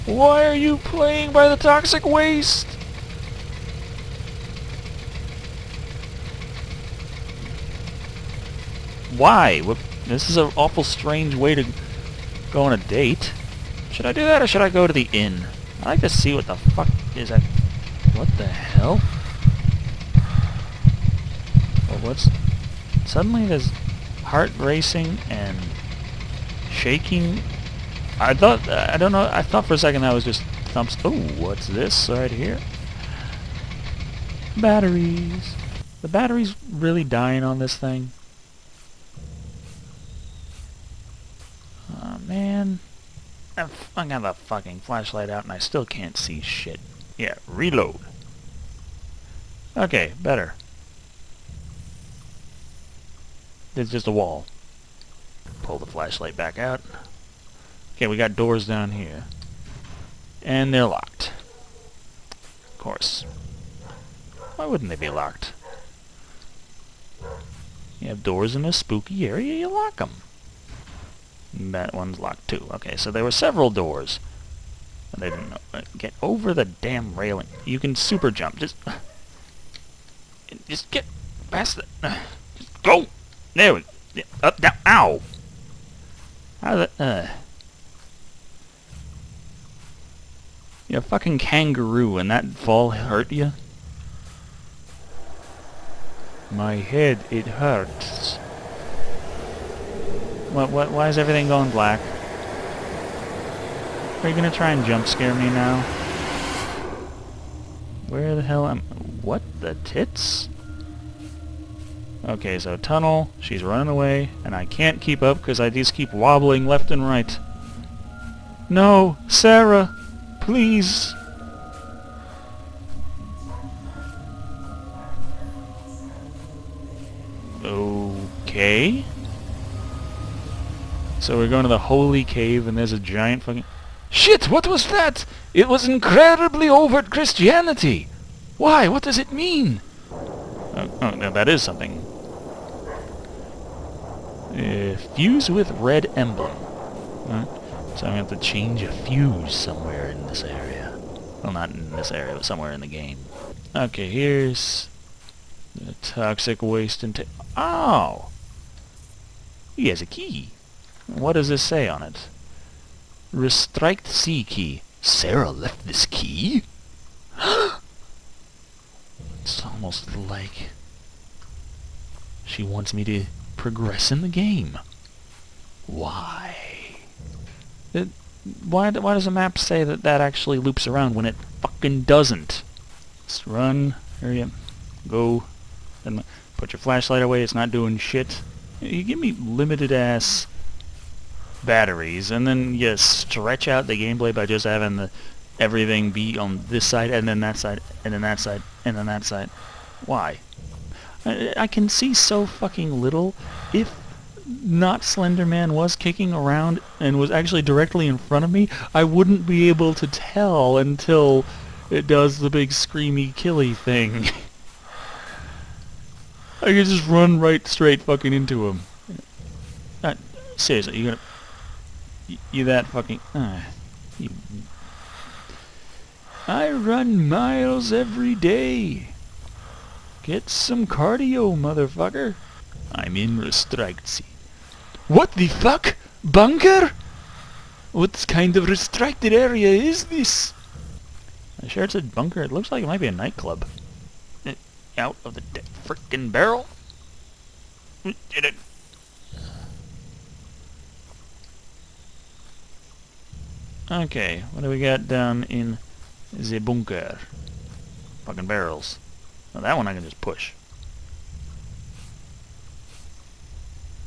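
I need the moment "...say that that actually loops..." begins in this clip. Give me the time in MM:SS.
02:59.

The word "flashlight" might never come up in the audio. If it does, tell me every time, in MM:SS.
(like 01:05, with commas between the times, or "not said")
00:44, 00:55, 03:06.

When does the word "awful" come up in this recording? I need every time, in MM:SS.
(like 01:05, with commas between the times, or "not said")
00:10.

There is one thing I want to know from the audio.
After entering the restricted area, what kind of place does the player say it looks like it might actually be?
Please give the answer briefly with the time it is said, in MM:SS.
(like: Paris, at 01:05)
A nightclub, at 04:03.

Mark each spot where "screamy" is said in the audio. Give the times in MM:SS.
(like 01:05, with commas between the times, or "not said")
03:32.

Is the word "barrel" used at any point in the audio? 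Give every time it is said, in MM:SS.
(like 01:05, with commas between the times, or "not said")
04:06, 04:18.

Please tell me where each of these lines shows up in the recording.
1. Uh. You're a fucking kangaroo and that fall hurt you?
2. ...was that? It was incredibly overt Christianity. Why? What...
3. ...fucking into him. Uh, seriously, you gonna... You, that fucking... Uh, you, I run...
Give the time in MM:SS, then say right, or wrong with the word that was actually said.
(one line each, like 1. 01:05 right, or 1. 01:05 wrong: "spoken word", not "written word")
1. 01:26 right
2. 02:14 right
3. 03:38 right.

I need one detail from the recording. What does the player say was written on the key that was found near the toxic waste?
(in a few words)
Restrict C key.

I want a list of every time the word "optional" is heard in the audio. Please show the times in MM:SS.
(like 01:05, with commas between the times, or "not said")
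not said.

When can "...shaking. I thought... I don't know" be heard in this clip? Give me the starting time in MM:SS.
00:26.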